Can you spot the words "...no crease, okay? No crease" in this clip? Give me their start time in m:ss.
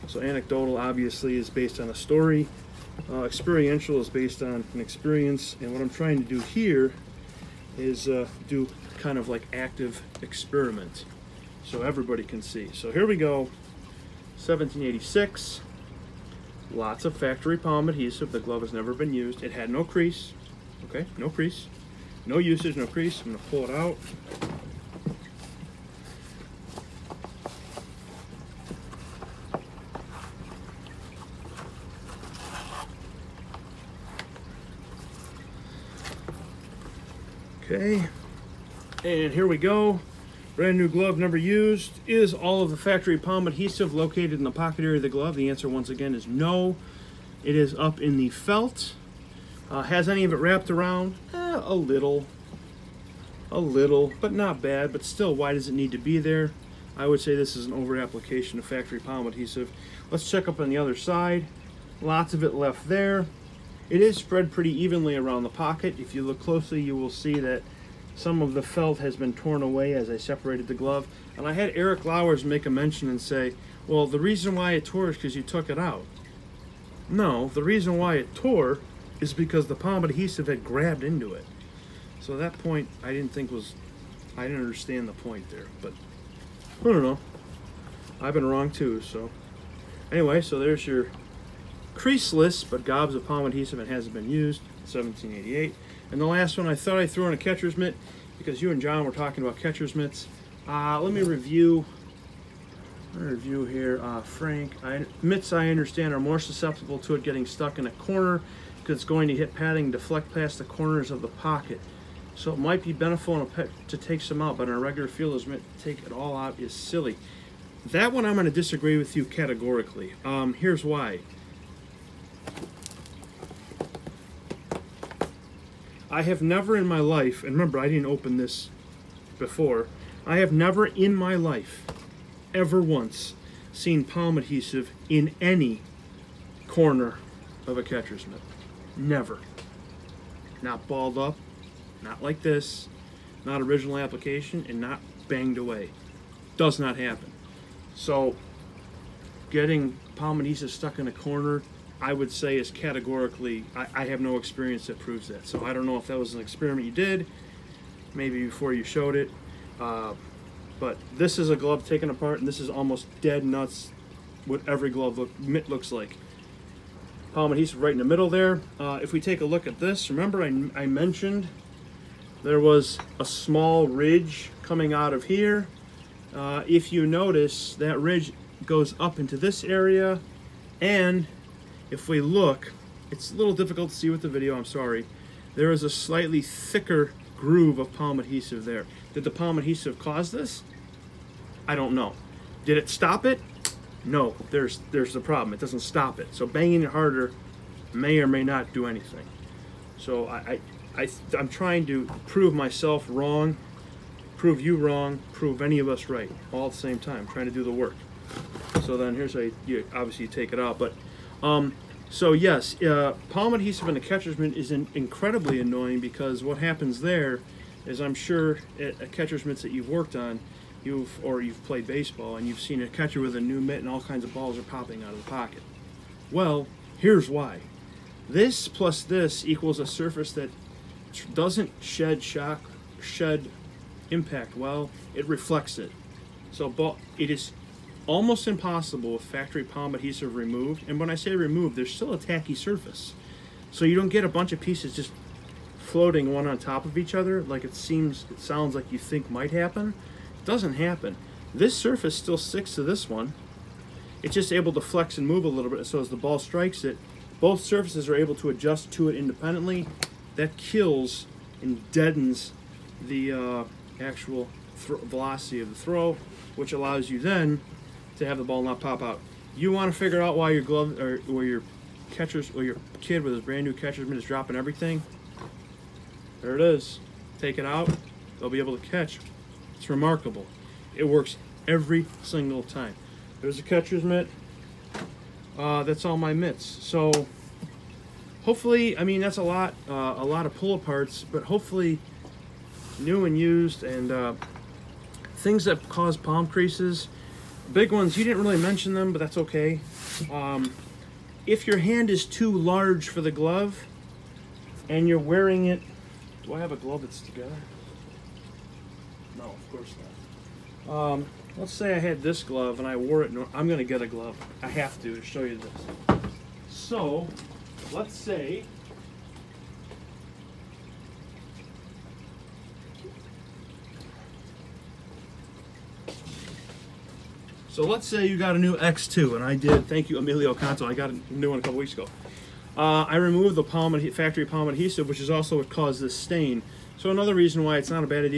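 0:19.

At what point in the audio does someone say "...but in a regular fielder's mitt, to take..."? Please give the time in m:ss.
1:54.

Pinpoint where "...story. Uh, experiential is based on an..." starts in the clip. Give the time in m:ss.
0:01.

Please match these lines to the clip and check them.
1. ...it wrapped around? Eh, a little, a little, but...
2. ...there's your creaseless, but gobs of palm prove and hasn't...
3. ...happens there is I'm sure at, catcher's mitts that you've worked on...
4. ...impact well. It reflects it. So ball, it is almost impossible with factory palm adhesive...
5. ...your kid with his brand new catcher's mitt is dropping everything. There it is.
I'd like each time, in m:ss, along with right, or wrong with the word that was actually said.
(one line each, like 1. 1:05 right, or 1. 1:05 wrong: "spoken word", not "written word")
1. 0:50 right
2. 1:30 wrong: "adhesive", not "prove"
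3. 3:36 right
4. 3:54 right
5. 4:32 right.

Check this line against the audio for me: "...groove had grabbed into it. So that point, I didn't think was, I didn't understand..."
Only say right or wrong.
wrong.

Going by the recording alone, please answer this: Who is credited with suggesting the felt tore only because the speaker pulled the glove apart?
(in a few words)
Eric Lowers.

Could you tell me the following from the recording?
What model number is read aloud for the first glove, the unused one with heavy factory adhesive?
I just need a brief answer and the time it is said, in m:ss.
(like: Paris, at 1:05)
1786, at 0:14.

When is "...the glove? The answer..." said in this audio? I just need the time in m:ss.
0:45.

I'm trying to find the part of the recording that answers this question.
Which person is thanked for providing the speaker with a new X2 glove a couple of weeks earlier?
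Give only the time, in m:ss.
5:30.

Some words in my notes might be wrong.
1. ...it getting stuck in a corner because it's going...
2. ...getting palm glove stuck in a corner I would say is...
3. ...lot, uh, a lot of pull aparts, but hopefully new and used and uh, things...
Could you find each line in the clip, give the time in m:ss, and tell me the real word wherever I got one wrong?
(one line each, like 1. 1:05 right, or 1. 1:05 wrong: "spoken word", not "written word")
1. 1:47 right
2. 2:29 wrong: "adhesive", not "glove"
3. 4:49 right.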